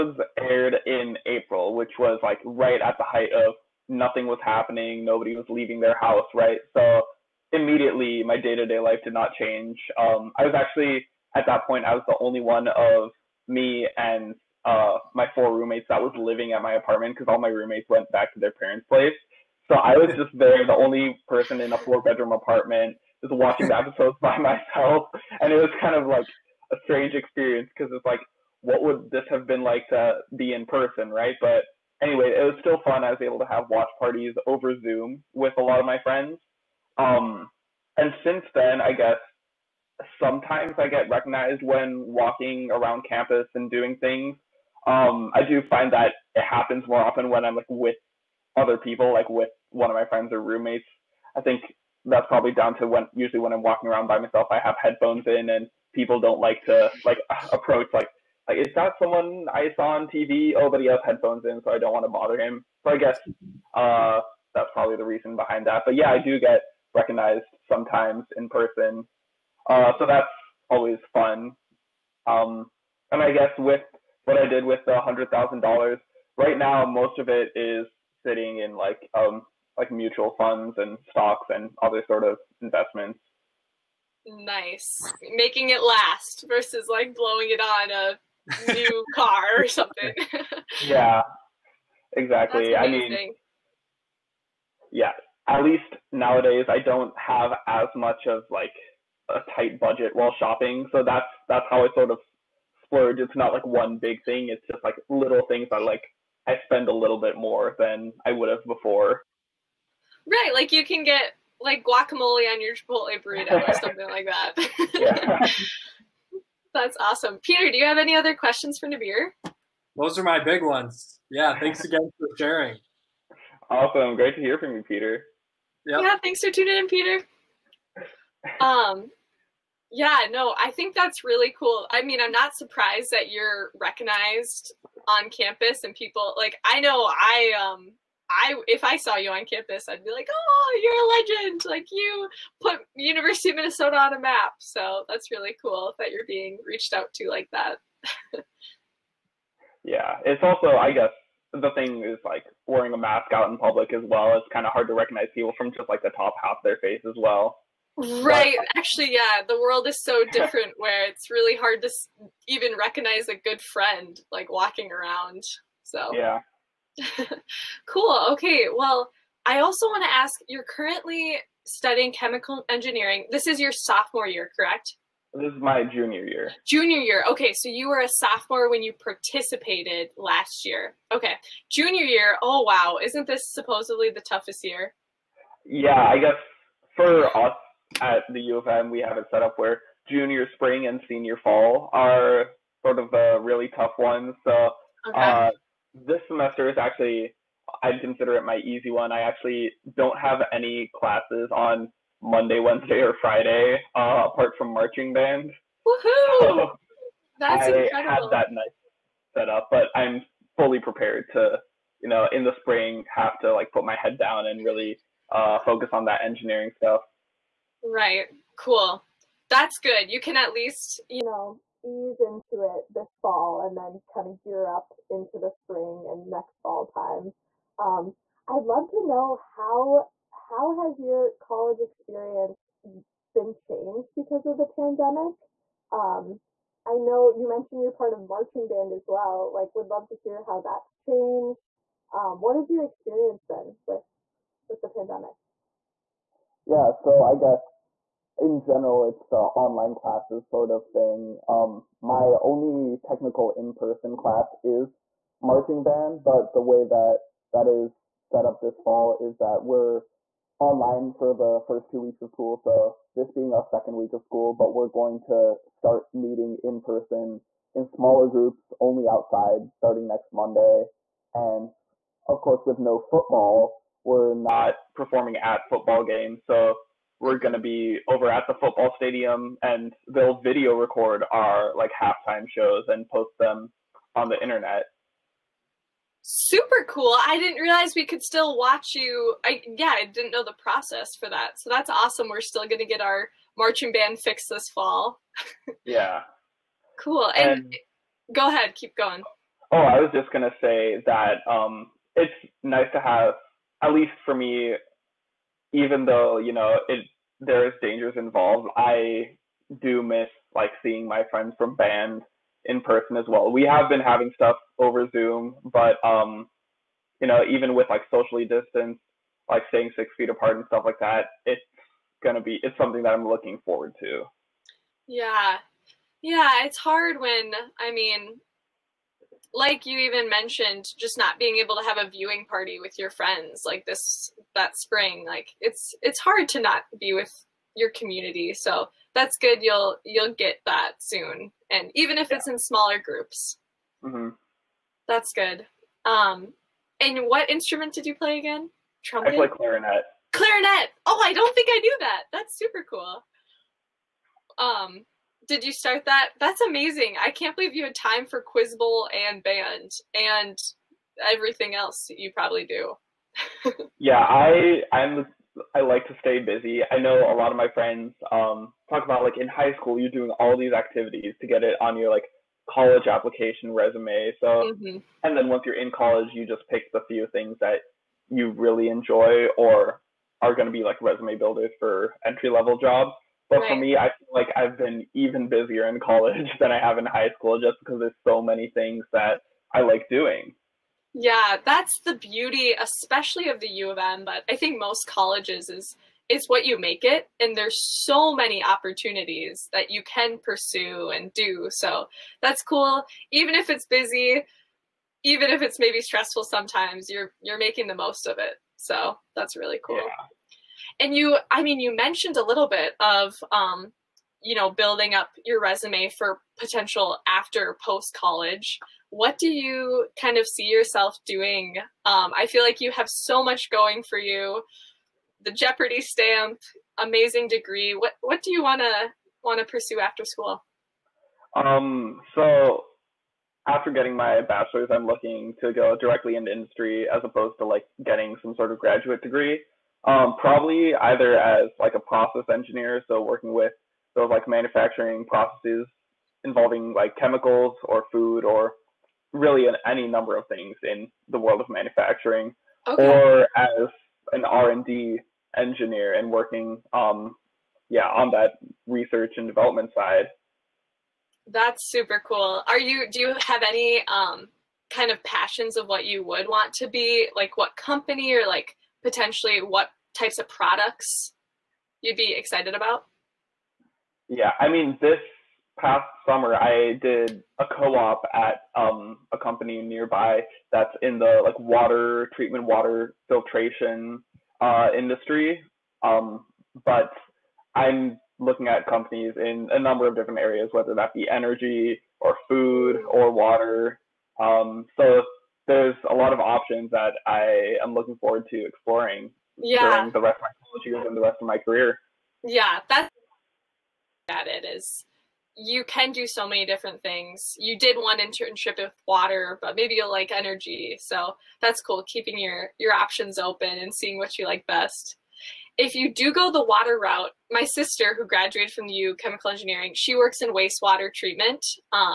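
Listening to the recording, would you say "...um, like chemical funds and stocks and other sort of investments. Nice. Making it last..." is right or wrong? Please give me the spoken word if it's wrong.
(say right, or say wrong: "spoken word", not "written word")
wrong: "mutual", not "chemical".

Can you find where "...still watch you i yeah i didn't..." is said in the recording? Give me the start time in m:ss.
4:48.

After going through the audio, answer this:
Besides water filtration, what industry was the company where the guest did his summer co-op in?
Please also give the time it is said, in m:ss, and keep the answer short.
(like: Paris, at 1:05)
water treatment, at 8:01.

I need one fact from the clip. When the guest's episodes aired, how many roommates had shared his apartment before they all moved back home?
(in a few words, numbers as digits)
4.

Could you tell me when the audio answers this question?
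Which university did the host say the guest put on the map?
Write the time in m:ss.
2:22.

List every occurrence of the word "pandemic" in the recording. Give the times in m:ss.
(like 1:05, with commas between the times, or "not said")
3:54, 4:04.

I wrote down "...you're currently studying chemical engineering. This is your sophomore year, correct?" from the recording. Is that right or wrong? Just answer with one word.
right.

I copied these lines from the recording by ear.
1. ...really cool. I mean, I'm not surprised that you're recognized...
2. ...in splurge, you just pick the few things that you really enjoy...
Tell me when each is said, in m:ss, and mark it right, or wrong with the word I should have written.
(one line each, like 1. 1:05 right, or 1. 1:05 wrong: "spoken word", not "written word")
1. 2:11 right
2. 6:15 wrong: "college", not "splurge".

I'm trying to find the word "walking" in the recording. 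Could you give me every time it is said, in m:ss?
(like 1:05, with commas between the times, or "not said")
0:42, 0:53, 2:44.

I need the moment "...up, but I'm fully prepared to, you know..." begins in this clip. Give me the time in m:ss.
3:29.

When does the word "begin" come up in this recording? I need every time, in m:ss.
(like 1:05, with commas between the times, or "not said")
not said.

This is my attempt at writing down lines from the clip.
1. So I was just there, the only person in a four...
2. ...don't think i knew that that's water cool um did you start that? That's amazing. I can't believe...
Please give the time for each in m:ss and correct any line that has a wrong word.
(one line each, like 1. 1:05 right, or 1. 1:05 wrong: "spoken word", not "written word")
1. 0:19 right
2. 5:51 wrong: "super", not "water".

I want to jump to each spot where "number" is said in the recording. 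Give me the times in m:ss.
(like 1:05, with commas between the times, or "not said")
7:30, 8:09.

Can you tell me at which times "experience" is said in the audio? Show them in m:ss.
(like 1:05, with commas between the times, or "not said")
0:27, 3:51, 4:02.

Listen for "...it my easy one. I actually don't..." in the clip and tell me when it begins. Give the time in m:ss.
3:18.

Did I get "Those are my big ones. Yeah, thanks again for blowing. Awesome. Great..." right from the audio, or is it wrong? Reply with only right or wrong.
wrong.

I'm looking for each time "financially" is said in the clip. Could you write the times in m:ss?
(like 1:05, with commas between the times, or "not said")
not said.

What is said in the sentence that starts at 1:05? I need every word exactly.
But yeah, I do get recognized sometimes in person, uh, so that's always fun.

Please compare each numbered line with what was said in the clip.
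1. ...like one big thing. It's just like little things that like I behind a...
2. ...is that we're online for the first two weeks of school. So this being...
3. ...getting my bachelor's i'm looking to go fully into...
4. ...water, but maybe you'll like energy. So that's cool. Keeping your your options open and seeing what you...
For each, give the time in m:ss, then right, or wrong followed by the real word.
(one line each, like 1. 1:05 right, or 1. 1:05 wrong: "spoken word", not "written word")
1. 1:43 wrong: "spend", not "behind"
2. 4:19 right
3. 7:13 wrong: "directly", not "fully"
4. 8:29 right.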